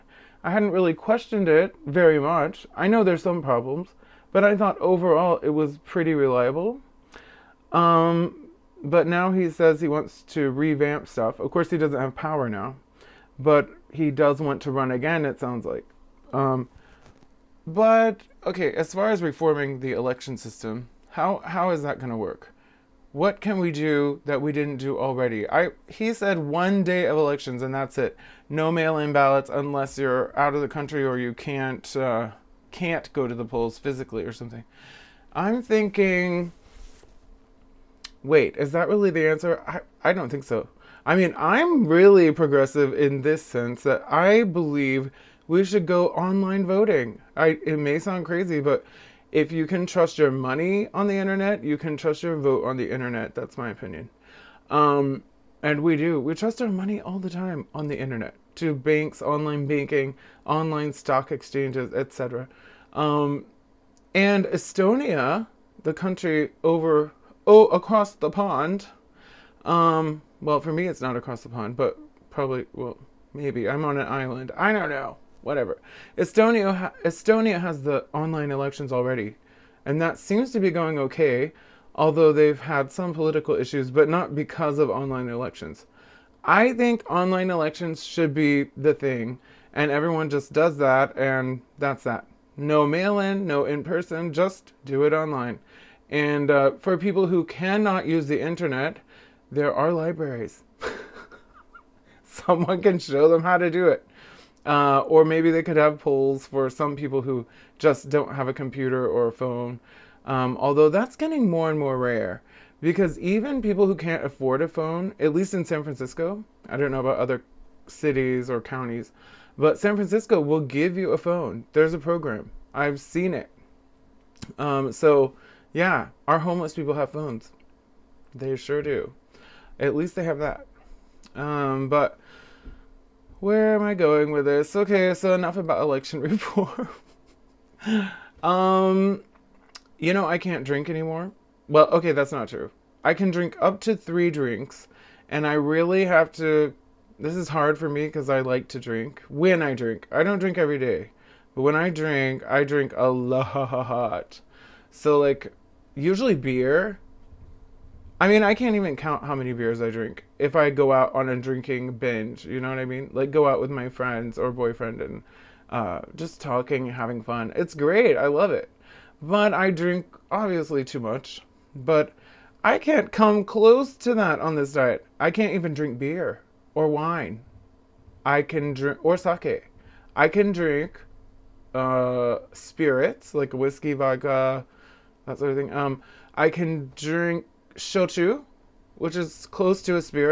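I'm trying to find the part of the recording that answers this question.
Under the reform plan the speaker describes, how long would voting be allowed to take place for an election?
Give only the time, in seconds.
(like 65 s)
26 s.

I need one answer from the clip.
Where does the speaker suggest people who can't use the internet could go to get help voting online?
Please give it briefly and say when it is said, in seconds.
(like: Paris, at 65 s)
libraries, at 99 s.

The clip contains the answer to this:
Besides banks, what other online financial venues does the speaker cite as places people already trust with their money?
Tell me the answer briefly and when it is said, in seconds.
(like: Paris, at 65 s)
stock exchanges, at 60 s.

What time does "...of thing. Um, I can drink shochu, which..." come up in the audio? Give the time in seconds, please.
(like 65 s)
185 s.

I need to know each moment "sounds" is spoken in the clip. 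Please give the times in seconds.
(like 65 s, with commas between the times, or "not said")
15 s, 47 s.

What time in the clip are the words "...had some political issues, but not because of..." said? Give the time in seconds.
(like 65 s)
82 s.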